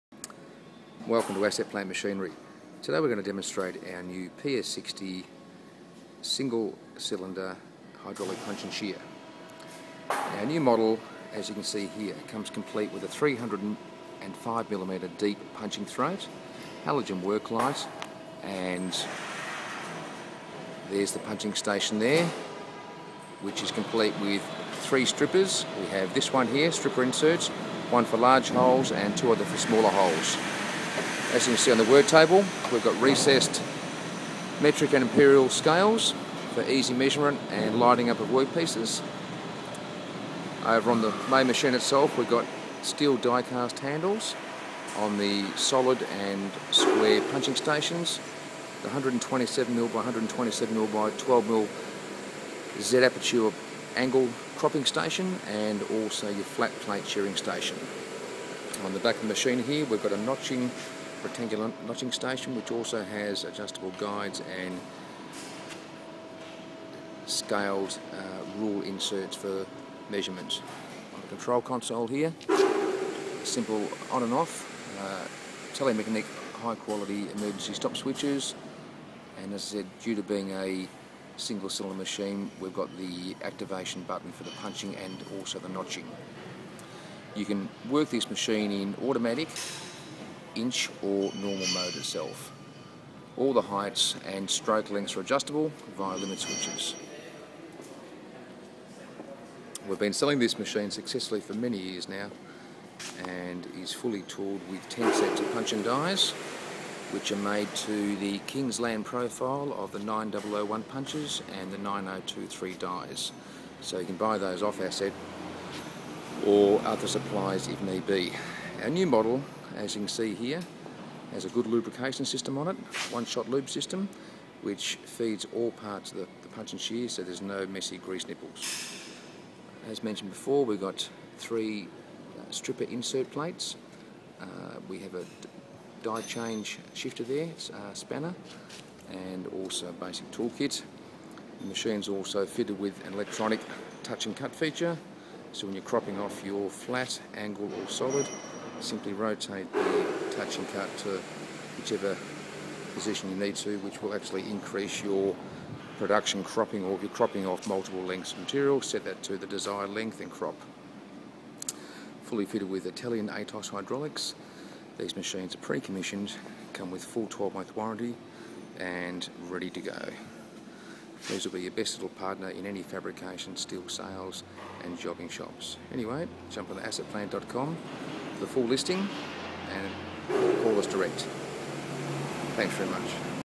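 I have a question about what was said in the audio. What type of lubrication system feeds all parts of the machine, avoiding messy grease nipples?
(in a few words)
One-shot lube system.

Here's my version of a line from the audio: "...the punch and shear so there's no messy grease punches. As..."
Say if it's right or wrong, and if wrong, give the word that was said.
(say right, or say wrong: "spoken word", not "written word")
wrong: "nipples", not "punches".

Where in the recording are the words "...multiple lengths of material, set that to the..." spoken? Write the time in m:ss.
2:37.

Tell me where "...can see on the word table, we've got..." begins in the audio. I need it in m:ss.
0:31.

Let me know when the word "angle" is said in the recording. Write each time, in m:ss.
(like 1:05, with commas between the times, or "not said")
0:53, 2:27.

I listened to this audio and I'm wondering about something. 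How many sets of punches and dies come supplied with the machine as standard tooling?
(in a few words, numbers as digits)
10.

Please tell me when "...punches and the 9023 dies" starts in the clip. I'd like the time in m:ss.
1:50.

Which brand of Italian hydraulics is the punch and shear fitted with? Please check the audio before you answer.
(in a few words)
ATOS.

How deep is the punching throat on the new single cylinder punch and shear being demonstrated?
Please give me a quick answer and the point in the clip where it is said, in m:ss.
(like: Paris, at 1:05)
305mm, at 0:13.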